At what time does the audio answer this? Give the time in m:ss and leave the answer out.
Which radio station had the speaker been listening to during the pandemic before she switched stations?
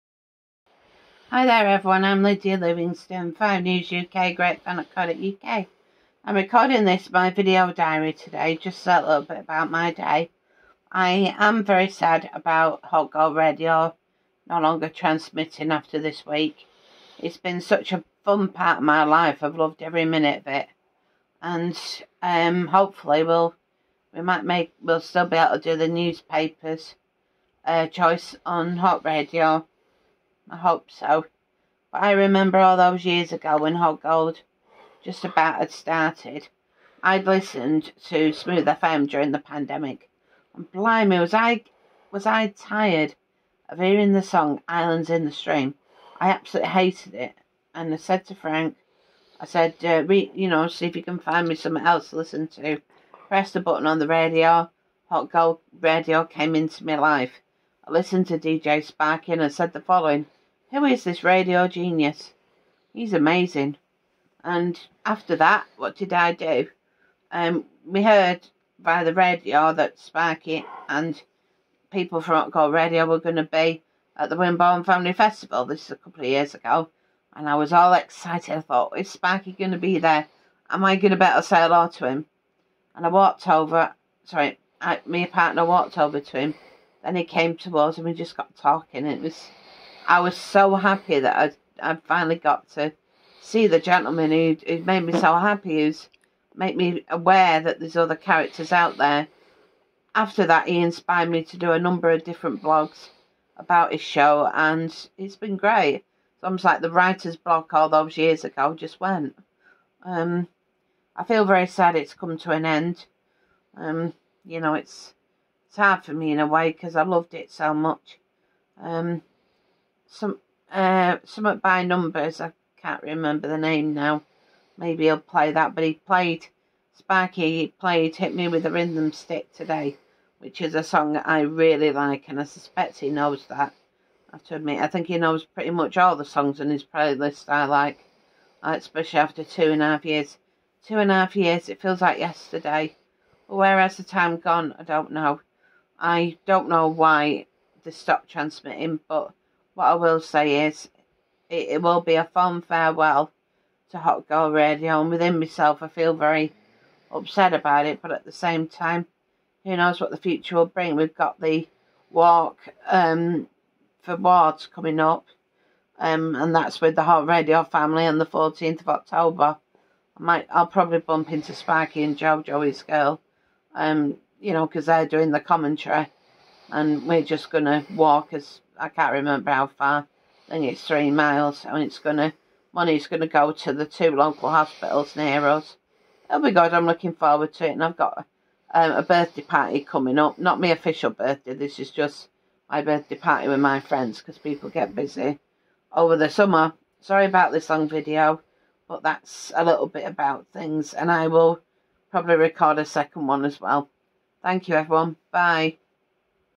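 0:38.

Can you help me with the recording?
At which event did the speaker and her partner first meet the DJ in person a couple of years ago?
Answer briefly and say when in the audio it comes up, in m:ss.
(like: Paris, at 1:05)
Wimborne Family Festival, at 1:14.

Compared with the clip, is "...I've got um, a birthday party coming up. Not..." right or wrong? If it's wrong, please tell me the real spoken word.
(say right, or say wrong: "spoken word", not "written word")
right.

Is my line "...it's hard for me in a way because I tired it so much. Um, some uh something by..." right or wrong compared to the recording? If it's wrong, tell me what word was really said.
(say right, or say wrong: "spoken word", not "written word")
wrong: "loved", not "tired".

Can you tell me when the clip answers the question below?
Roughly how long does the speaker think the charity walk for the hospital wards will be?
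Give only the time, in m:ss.
3:00.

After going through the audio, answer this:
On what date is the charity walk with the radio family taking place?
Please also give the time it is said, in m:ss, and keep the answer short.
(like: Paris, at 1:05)
14 October, at 2:48.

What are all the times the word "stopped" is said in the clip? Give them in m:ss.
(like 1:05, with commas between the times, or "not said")
2:27.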